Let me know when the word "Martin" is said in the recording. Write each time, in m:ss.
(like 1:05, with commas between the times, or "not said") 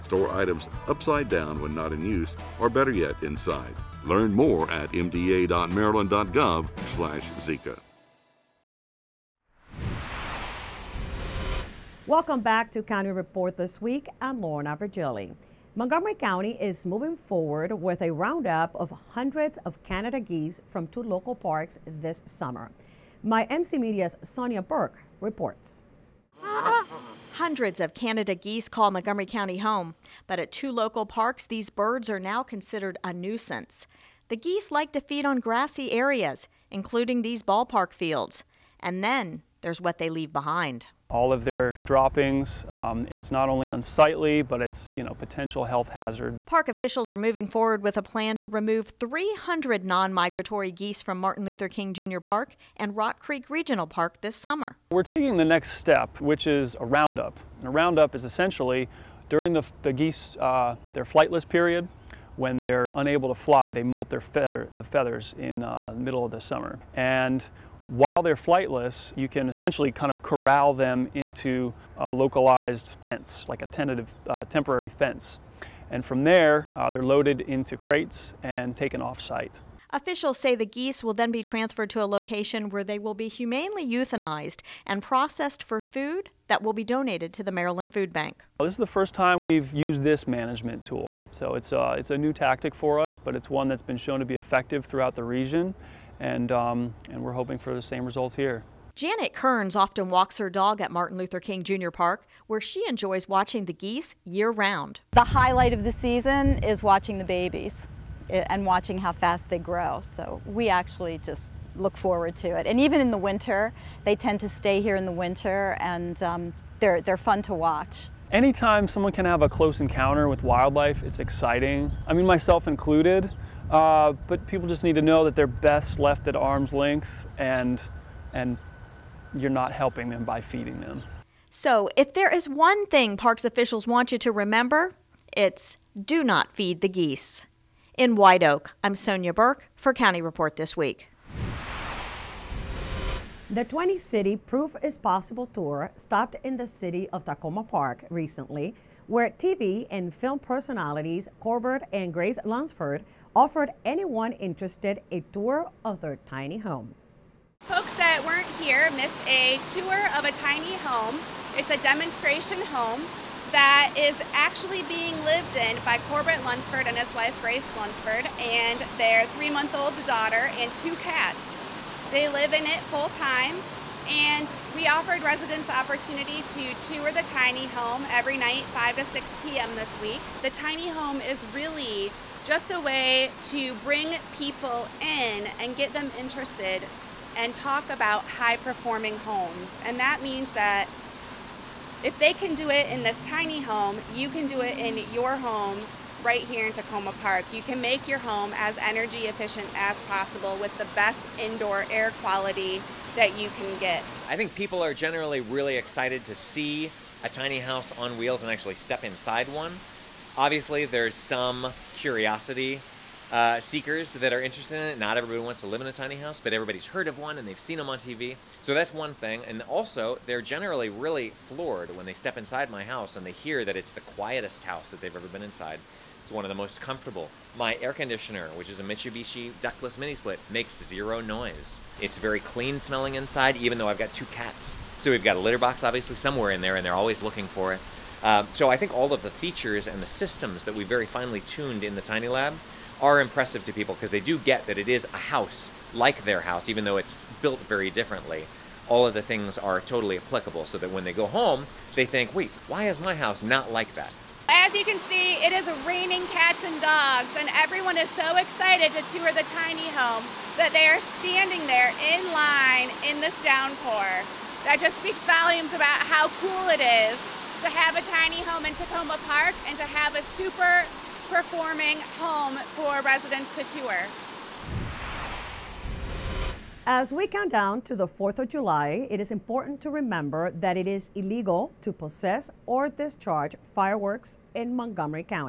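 0:51, 1:40.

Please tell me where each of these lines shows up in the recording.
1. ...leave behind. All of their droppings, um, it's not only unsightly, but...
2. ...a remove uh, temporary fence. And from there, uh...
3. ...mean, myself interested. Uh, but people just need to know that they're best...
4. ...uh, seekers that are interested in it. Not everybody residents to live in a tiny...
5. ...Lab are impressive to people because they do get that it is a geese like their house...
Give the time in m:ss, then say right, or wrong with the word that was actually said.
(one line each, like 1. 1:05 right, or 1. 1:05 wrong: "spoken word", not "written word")
1. 0:40 right
2. 1:13 wrong: "tentative", not "remove"
3. 2:02 wrong: "included", not "interested"
4. 3:33 wrong: "wants", not "residents"
5. 4:02 wrong: "house", not "geese".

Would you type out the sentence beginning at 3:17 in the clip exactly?
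You can make your home as energy efficient as possible with the best indoor air quality that you can get.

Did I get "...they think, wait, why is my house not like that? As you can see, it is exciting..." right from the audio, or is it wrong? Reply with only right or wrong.
wrong.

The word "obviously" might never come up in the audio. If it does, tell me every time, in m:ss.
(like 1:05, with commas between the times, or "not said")
3:30, 3:55.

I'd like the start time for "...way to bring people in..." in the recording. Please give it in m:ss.
3:02.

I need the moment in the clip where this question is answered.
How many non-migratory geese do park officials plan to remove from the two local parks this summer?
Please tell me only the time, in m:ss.
0:48.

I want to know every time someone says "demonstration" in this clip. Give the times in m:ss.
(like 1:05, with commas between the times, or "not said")
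2:41.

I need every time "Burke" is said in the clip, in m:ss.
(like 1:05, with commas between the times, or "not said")
0:24, 2:19.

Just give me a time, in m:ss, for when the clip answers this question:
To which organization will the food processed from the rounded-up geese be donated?
1:27.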